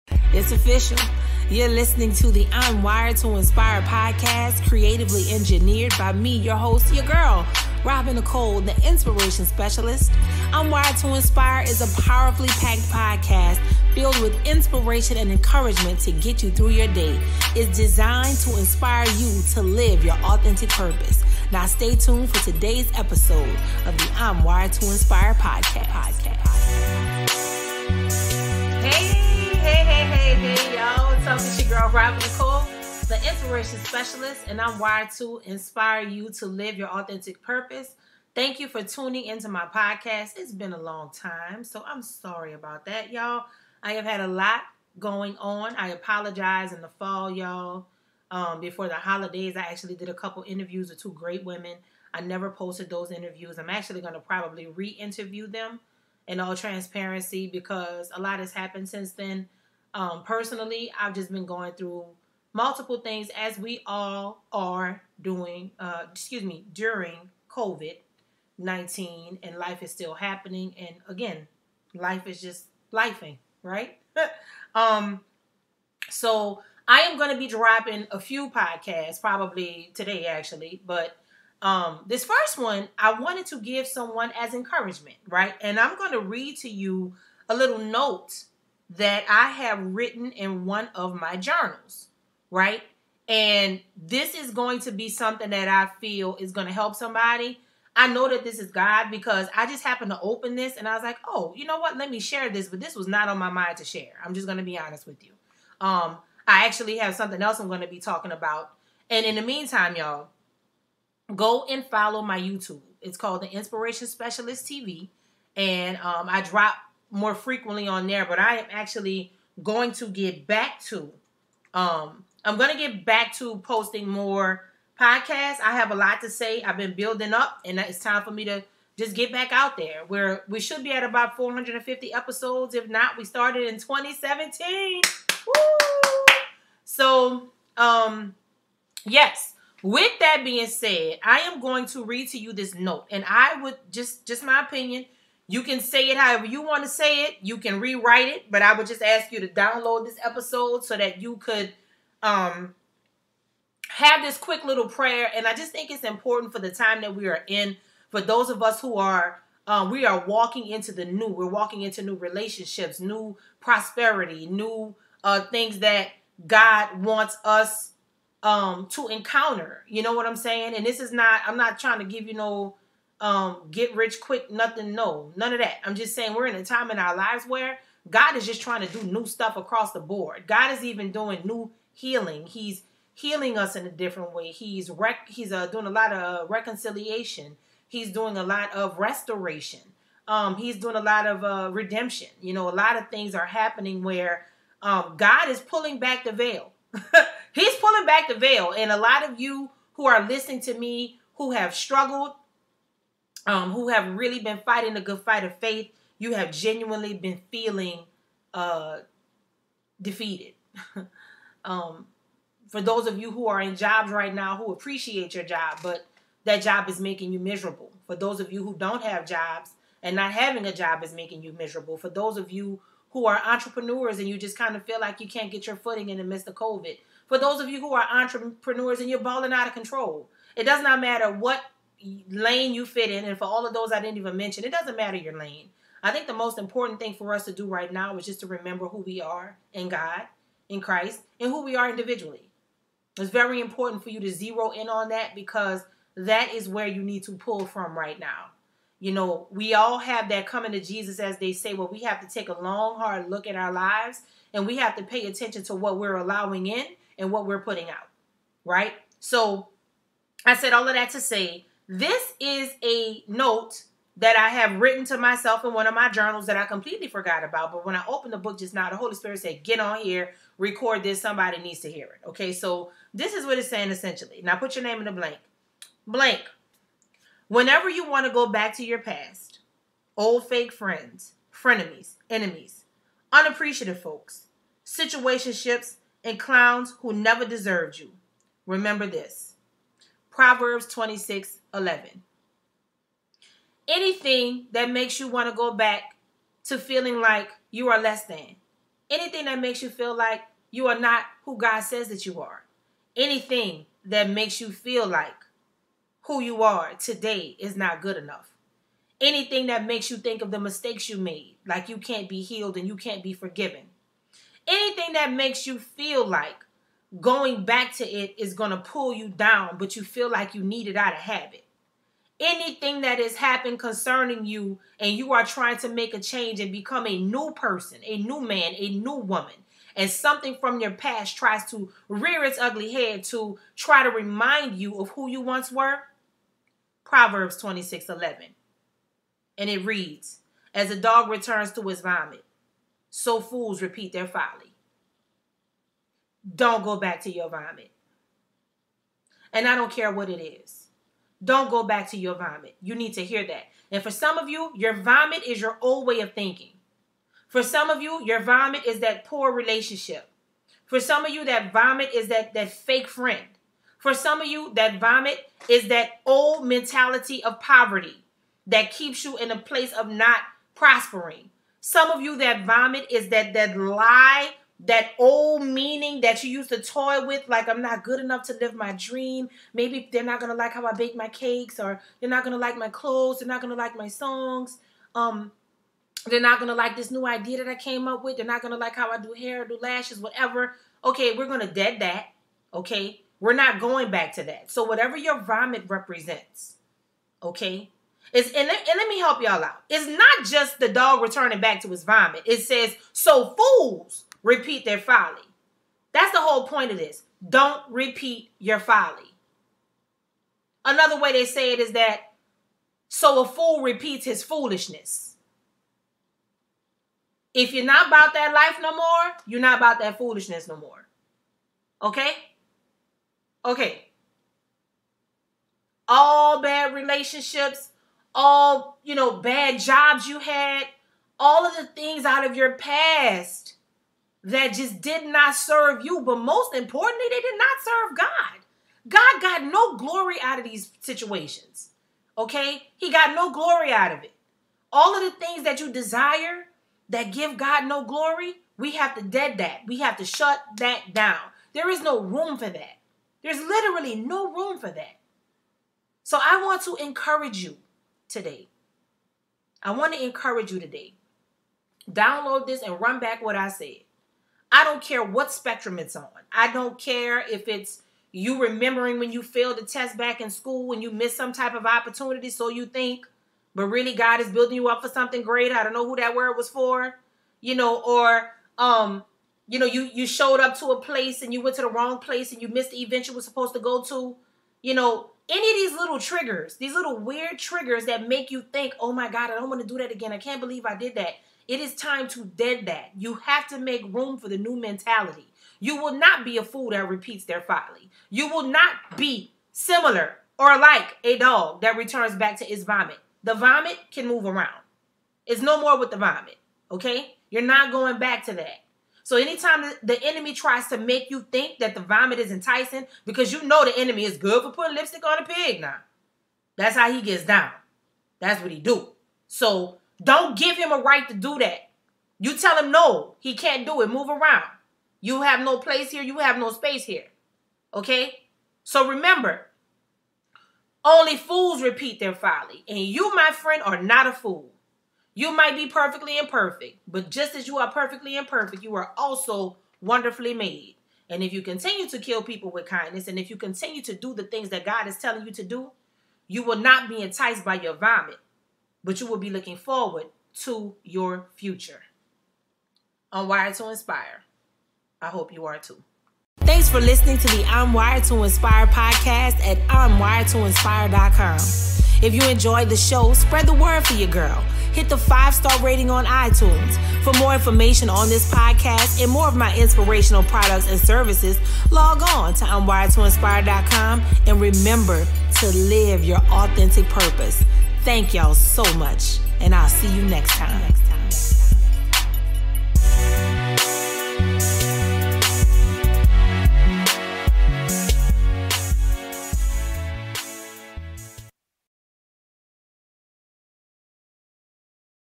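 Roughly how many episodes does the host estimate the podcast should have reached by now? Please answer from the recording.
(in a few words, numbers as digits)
450.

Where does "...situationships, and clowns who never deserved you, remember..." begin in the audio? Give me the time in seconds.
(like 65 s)
284 s.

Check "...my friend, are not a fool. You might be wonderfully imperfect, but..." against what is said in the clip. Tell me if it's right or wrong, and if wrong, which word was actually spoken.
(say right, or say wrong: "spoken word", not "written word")
wrong: "perfectly", not "wonderfully".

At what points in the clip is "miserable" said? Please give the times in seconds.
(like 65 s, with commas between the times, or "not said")
217 s, 221 s.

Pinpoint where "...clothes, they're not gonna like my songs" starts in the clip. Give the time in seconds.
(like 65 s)
382 s.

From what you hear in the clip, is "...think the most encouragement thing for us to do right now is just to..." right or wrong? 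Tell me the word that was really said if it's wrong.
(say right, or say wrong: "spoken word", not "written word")
wrong: "important", not "encouragement".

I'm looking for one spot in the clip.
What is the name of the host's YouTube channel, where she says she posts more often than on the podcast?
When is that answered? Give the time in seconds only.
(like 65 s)
113 s.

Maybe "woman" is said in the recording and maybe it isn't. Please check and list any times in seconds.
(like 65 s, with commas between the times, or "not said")
329 s.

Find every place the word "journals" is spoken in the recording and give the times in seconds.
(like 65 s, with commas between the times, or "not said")
91 s, 266 s.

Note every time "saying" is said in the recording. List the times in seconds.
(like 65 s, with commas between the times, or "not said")
170 s, 176 s, 273 s.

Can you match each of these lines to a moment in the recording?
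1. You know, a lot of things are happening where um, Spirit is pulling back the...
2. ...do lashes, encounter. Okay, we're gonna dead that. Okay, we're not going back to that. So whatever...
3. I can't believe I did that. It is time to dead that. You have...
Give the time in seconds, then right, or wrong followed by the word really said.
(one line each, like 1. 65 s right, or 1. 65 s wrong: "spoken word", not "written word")
1. 192 s wrong: "God", not "Spirit"
2. 389 s wrong: "whatever", not "encounter"
3. 490 s right.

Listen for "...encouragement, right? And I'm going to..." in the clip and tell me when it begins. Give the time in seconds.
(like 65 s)
84 s.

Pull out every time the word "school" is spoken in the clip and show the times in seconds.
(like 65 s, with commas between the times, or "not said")
470 s.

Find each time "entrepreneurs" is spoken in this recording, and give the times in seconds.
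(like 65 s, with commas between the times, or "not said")
223 s, 228 s.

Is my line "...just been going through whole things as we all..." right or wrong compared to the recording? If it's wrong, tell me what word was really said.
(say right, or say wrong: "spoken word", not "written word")
wrong: "multiple", not "whole".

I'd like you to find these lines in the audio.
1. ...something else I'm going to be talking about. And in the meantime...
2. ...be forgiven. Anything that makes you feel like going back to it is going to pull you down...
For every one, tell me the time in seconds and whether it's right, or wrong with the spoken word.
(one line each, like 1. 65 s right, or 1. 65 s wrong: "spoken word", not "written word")
1. 107 s right
2. 313 s right.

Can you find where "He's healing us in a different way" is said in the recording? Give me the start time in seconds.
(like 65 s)
182 s.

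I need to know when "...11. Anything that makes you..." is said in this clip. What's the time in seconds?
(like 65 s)
291 s.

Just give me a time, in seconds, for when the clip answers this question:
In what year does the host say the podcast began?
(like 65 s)
133 s.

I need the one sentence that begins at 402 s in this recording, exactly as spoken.
It says, so fools repeat their folly.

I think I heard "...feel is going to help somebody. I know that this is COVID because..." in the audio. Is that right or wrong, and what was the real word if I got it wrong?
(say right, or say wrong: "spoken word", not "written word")
wrong: "God", not "COVID".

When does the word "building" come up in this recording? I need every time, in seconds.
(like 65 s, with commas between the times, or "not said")
126 s, 474 s.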